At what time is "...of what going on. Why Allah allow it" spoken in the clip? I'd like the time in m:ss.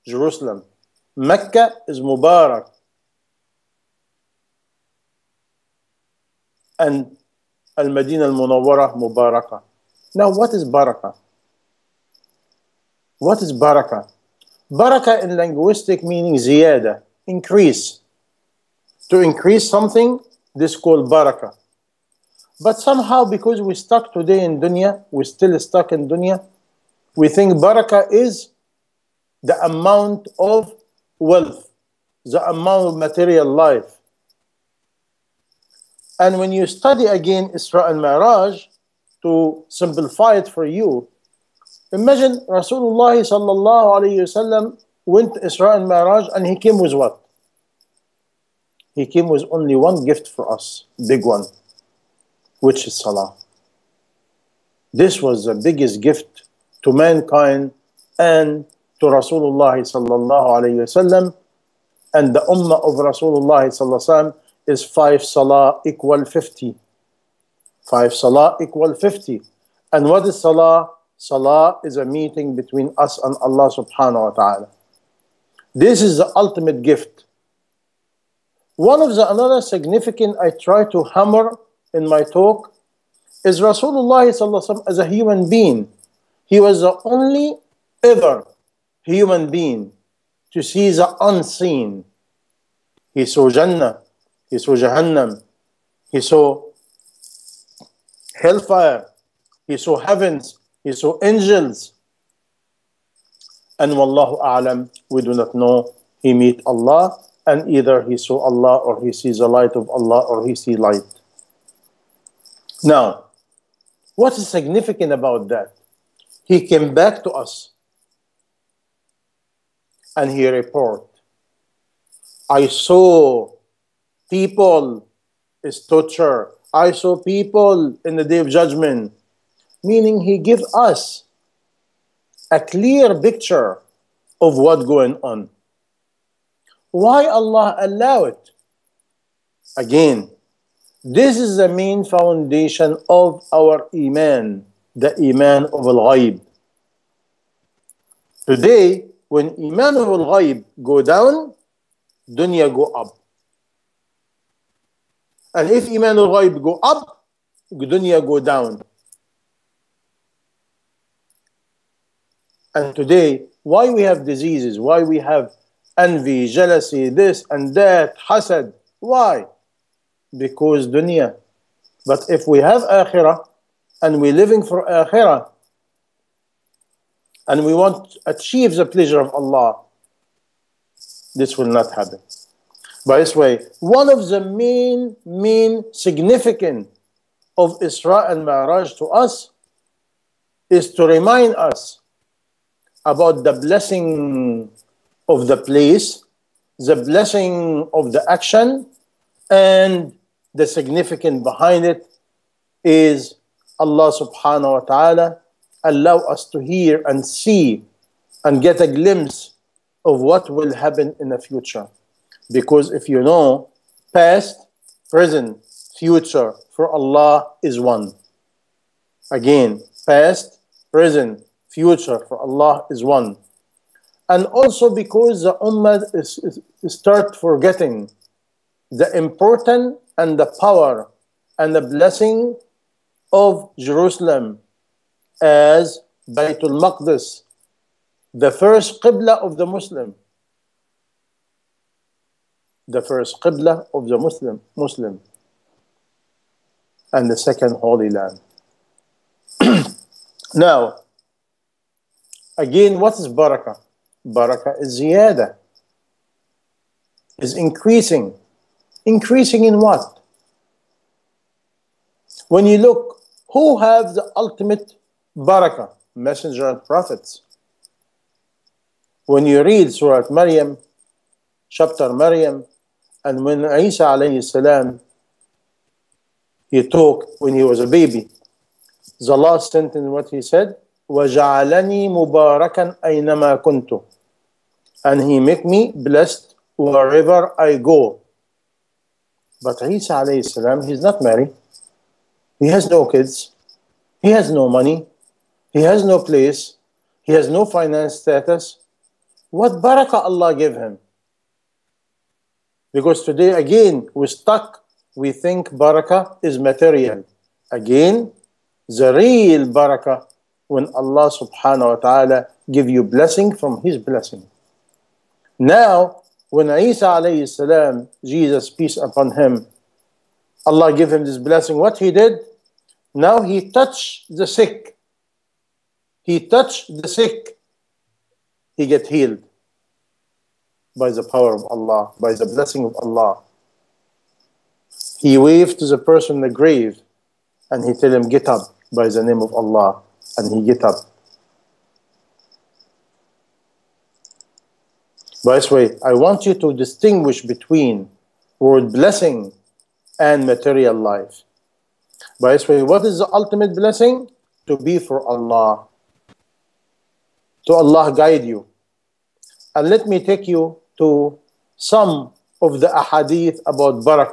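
2:14.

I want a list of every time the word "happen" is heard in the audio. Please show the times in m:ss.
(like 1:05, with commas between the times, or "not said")
3:01, 3:30.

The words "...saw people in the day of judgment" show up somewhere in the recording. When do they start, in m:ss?
2:06.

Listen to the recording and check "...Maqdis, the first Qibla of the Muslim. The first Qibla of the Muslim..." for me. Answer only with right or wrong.
right.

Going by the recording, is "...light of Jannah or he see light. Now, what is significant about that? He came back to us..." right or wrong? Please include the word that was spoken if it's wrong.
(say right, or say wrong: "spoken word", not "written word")
wrong: "Allah", not "Jannah".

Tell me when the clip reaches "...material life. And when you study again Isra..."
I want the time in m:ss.
0:32.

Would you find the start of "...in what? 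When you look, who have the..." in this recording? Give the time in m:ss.
4:19.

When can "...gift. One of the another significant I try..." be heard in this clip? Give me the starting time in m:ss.
1:16.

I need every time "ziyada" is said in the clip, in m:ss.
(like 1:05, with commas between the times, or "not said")
0:16, 4:15.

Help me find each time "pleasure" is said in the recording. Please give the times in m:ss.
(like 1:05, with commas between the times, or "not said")
2:58.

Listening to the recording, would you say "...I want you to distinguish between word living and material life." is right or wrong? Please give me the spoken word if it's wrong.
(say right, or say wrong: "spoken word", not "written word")
wrong: "blessing", not "living".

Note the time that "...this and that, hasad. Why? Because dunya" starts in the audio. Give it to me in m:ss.
2:47.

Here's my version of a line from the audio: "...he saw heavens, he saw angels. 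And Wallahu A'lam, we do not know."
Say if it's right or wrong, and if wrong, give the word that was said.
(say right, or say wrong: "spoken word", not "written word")
right.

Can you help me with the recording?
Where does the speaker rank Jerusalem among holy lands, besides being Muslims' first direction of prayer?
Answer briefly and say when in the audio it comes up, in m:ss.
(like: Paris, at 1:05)
Second Holy Land, at 4:07.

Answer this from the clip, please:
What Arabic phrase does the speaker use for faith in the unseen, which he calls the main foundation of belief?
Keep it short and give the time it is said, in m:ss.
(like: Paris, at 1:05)
Iman of Al-Ghaib, at 2:25.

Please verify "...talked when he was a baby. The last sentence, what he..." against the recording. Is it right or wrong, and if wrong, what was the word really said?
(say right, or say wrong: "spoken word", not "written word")
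right.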